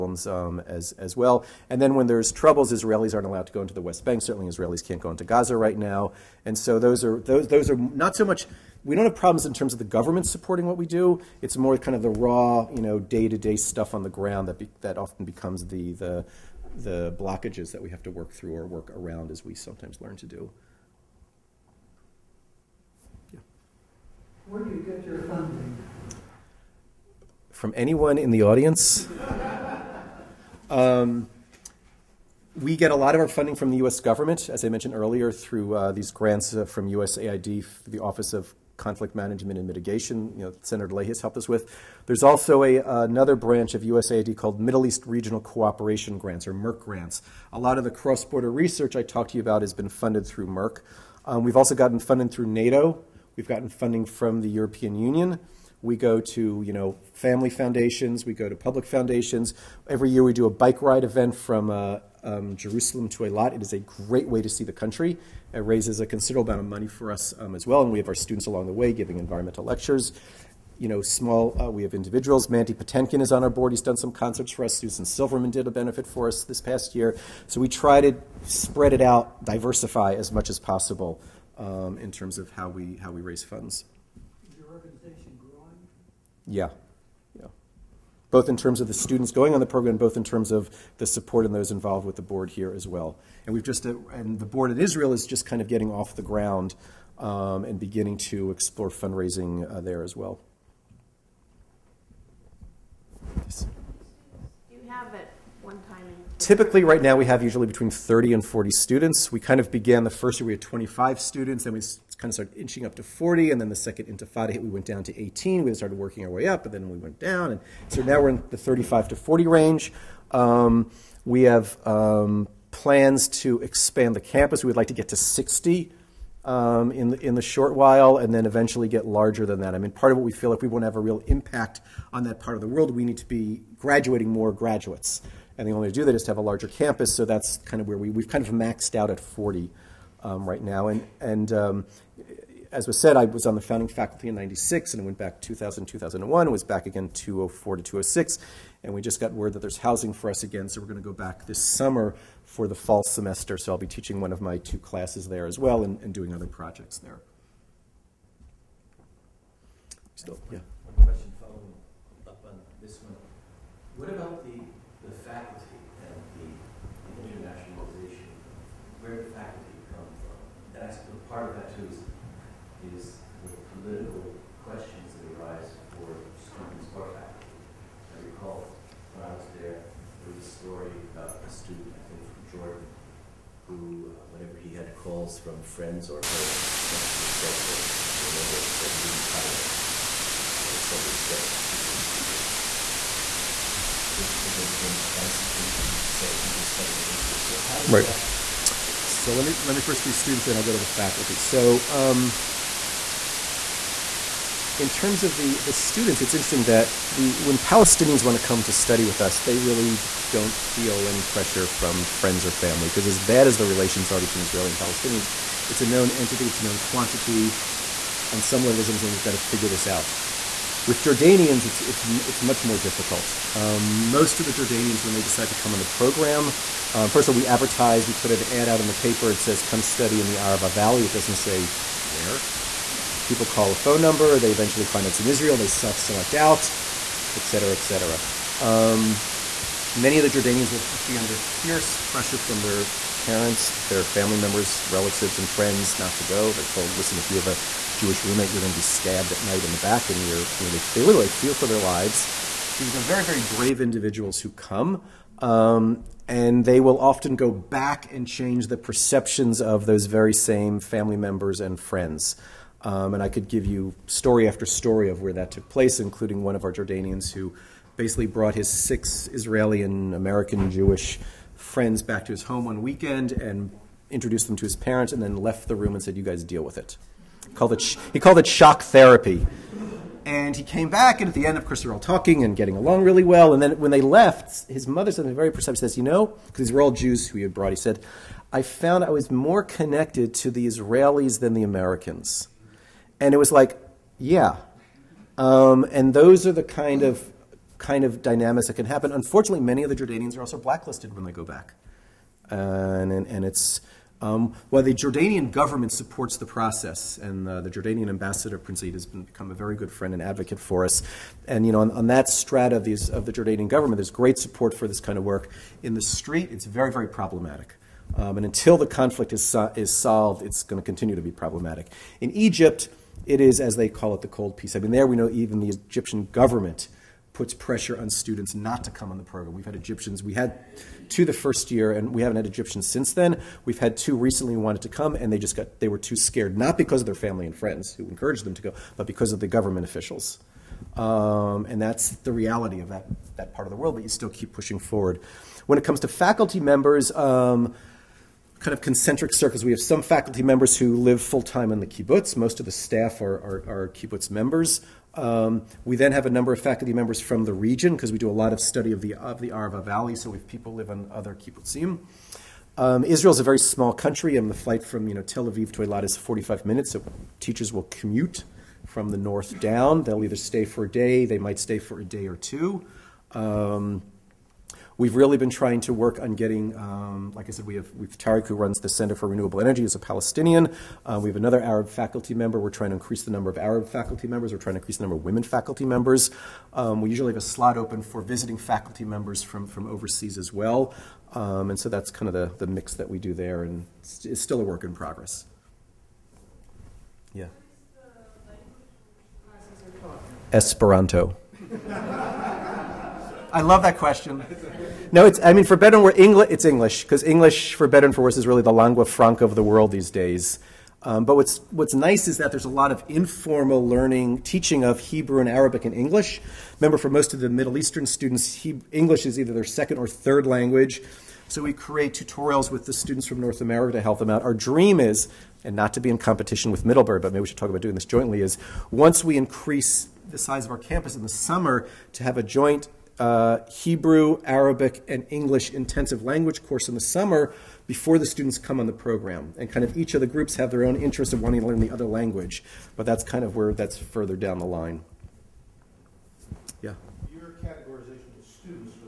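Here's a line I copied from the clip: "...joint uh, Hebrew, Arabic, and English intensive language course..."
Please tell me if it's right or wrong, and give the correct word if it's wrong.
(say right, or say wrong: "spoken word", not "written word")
right.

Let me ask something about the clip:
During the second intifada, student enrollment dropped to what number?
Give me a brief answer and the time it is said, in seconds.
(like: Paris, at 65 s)
18, at 115 s.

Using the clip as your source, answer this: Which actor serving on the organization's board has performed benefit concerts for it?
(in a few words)
Mandy Patinkin.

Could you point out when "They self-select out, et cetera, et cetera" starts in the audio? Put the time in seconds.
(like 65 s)
235 s.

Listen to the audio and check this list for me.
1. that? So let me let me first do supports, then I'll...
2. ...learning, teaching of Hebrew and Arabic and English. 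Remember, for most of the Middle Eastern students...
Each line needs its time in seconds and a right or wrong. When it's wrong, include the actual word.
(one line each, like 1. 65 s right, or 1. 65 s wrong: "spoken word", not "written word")
1. 198 s wrong: "students", not "supports"
2. 413 s right.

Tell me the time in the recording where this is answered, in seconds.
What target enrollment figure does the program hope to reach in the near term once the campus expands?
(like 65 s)
125 s.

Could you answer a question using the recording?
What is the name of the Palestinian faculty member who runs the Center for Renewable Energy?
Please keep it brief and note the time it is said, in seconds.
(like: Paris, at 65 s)
Tariq, at 378 s.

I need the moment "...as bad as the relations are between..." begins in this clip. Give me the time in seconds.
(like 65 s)
213 s.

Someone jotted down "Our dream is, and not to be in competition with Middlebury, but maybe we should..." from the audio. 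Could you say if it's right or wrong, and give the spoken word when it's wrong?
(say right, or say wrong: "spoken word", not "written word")
right.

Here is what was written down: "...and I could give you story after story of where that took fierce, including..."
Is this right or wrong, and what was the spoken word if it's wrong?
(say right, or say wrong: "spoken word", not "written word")
wrong: "place", not "fierce".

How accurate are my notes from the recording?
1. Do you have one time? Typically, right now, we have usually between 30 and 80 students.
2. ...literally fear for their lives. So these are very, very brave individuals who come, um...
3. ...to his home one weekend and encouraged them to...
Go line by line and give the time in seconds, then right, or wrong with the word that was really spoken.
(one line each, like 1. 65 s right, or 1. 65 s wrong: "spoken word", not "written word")
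1. 104 s wrong: "40", not "80"
2. 251 s right
3. 272 s wrong: "introduced", not "encouraged".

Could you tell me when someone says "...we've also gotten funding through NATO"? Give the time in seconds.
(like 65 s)
51 s.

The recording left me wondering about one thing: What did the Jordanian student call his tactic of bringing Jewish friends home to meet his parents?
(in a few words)
shock therapy.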